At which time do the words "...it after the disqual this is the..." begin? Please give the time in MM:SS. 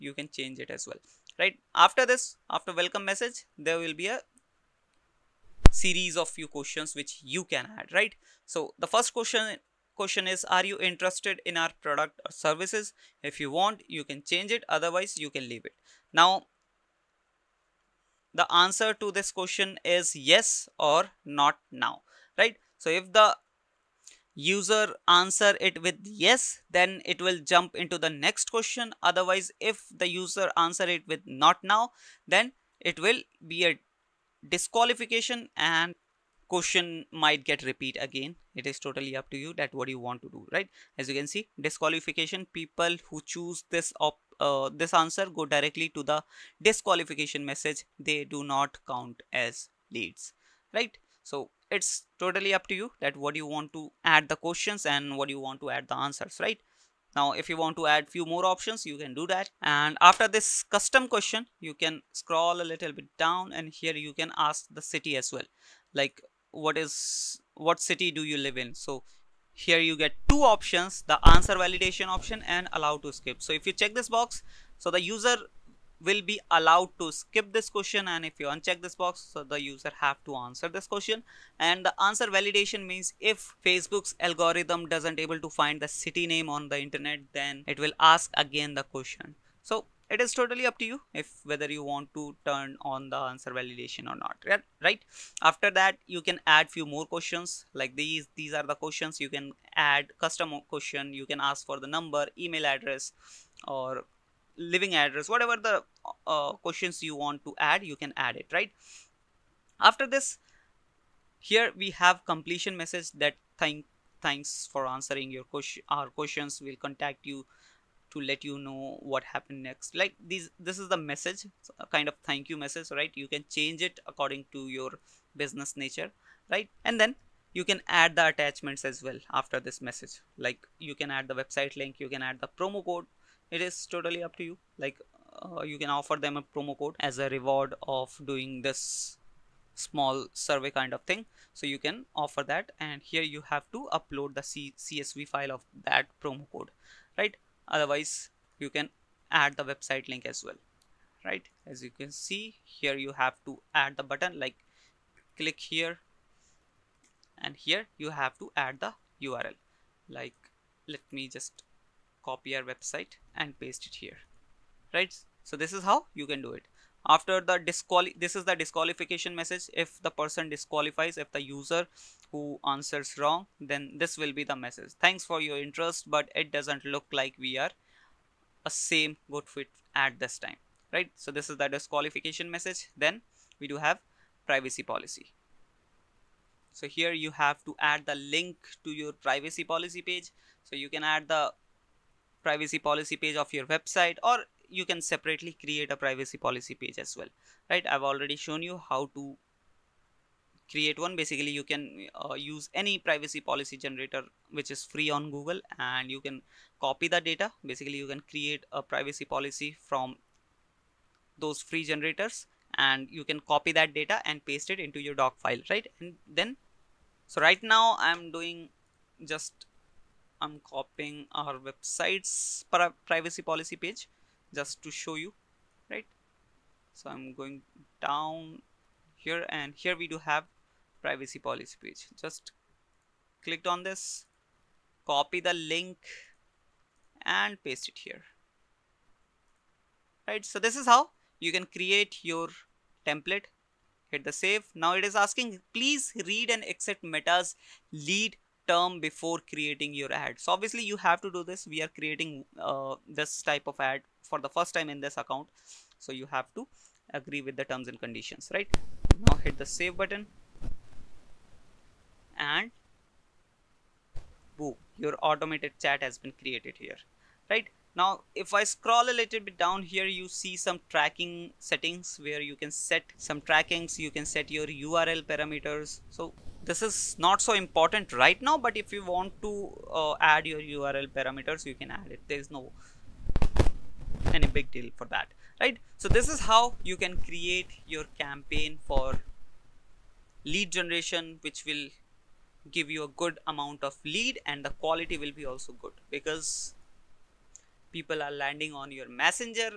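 02:46.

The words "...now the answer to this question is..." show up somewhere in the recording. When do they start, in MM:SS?
00:16.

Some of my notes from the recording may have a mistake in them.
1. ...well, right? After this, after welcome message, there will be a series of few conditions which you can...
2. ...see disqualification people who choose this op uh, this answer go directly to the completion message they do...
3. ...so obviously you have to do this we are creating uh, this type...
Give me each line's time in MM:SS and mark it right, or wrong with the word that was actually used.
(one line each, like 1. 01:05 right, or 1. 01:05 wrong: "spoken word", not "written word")
1. 00:00 wrong: "questions", not "conditions"
2. 00:41 wrong: "disqualification", not "completion"
3. 04:10 right.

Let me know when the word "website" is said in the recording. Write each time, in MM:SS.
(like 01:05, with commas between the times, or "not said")
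02:11, 02:29, 02:42, 03:13, 03:41.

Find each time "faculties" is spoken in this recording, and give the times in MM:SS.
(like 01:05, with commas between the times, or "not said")
not said.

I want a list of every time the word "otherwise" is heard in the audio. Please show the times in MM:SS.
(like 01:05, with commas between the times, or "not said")
00:14, 00:29, 02:27.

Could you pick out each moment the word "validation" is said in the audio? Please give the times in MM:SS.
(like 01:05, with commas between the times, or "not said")
01:11, 01:22, 01:33.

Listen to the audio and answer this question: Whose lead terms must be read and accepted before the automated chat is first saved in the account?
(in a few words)
Meta's.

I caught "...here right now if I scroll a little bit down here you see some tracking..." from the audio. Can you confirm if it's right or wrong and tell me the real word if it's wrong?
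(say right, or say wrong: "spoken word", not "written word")
right.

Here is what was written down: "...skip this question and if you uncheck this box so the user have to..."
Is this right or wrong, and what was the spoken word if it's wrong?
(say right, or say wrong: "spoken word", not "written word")
right.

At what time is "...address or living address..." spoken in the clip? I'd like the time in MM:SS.
01:42.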